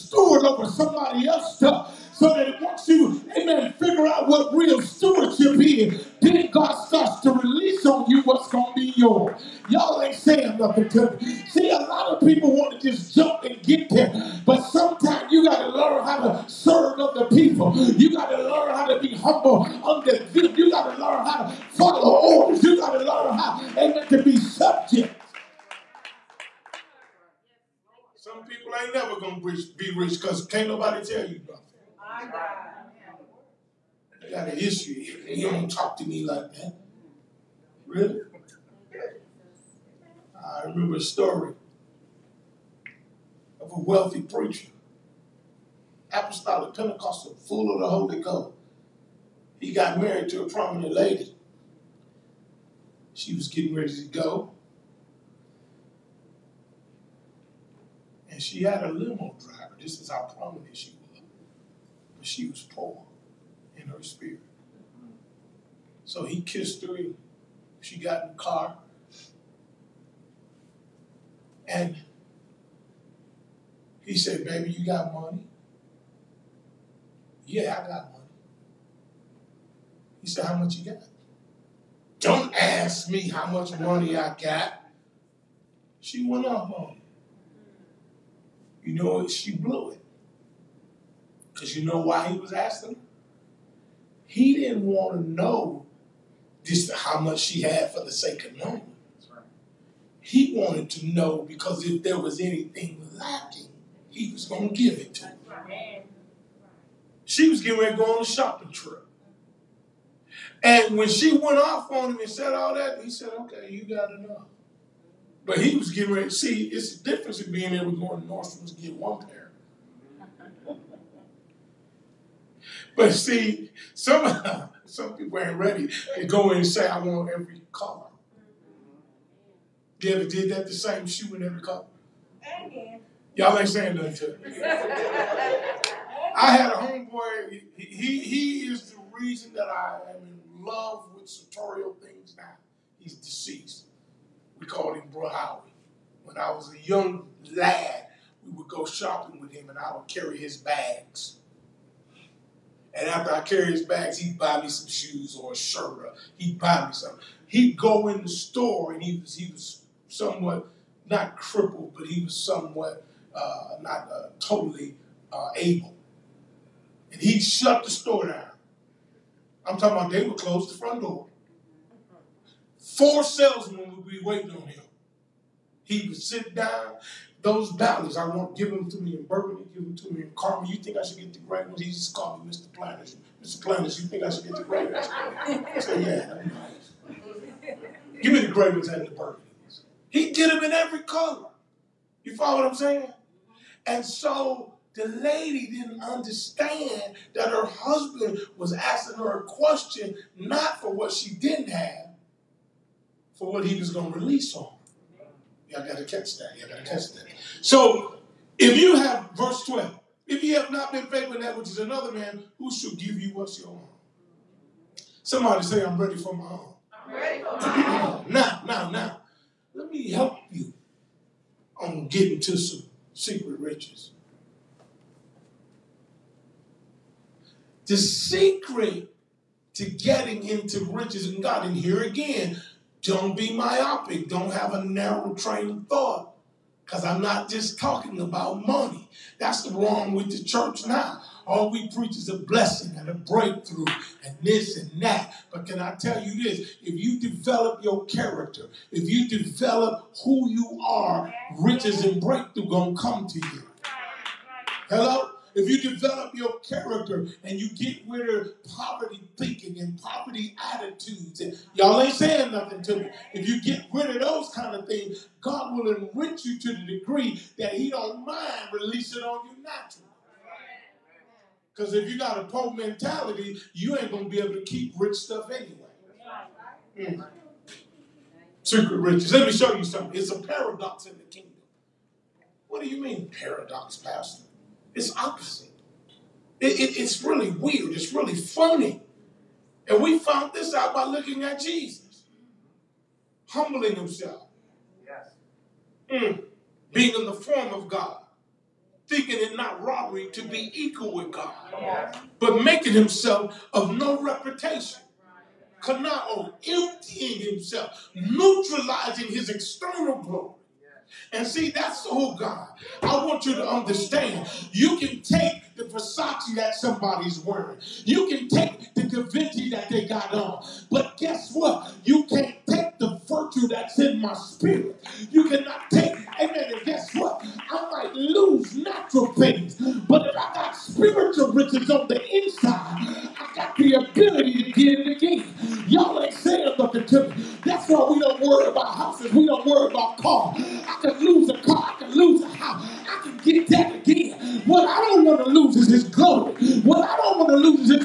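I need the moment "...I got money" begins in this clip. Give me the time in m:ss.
1:17.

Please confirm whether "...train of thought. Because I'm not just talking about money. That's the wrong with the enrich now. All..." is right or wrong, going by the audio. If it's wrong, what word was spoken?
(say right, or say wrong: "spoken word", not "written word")
wrong: "church", not "enrich".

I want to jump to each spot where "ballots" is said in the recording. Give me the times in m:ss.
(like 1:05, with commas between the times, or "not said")
2:57.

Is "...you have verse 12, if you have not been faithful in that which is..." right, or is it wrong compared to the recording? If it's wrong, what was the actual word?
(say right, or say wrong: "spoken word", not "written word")
right.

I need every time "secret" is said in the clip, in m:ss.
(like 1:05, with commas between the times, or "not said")
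3:43, 3:47, 4:38.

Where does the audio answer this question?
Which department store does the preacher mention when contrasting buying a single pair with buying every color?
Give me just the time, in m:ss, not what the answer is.
1:58.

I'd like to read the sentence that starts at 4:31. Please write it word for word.
Because if you got a poor mentality, you ain't gonna be able to keep rich stuff anyway.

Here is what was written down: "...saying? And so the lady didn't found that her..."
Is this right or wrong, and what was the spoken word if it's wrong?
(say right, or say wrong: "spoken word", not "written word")
wrong: "understand", not "found".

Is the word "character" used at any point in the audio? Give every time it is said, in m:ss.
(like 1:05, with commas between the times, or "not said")
4:08, 4:16.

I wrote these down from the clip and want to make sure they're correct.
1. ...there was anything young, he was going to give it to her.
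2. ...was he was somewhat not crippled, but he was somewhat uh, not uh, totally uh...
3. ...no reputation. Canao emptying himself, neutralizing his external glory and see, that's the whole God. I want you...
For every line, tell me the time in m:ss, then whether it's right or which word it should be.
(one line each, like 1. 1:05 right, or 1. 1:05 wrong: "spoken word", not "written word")
1. 1:42 wrong: "lacking", not "young"
2. 2:39 right
3. 5:03 right.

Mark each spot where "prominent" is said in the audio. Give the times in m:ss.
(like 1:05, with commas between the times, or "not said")
0:50, 1:00.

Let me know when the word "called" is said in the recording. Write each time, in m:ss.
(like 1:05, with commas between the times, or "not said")
2:24, 3:02.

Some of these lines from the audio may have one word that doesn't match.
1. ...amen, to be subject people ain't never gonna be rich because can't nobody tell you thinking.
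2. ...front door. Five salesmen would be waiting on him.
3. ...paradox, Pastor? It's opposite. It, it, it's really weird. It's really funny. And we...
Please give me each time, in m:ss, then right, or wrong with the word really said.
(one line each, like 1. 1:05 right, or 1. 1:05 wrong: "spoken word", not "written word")
1. 0:23 wrong: "nothing", not "thinking"
2. 2:50 wrong: "Four", not "Five"
3. 4:43 right.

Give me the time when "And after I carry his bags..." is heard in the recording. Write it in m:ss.
2:32.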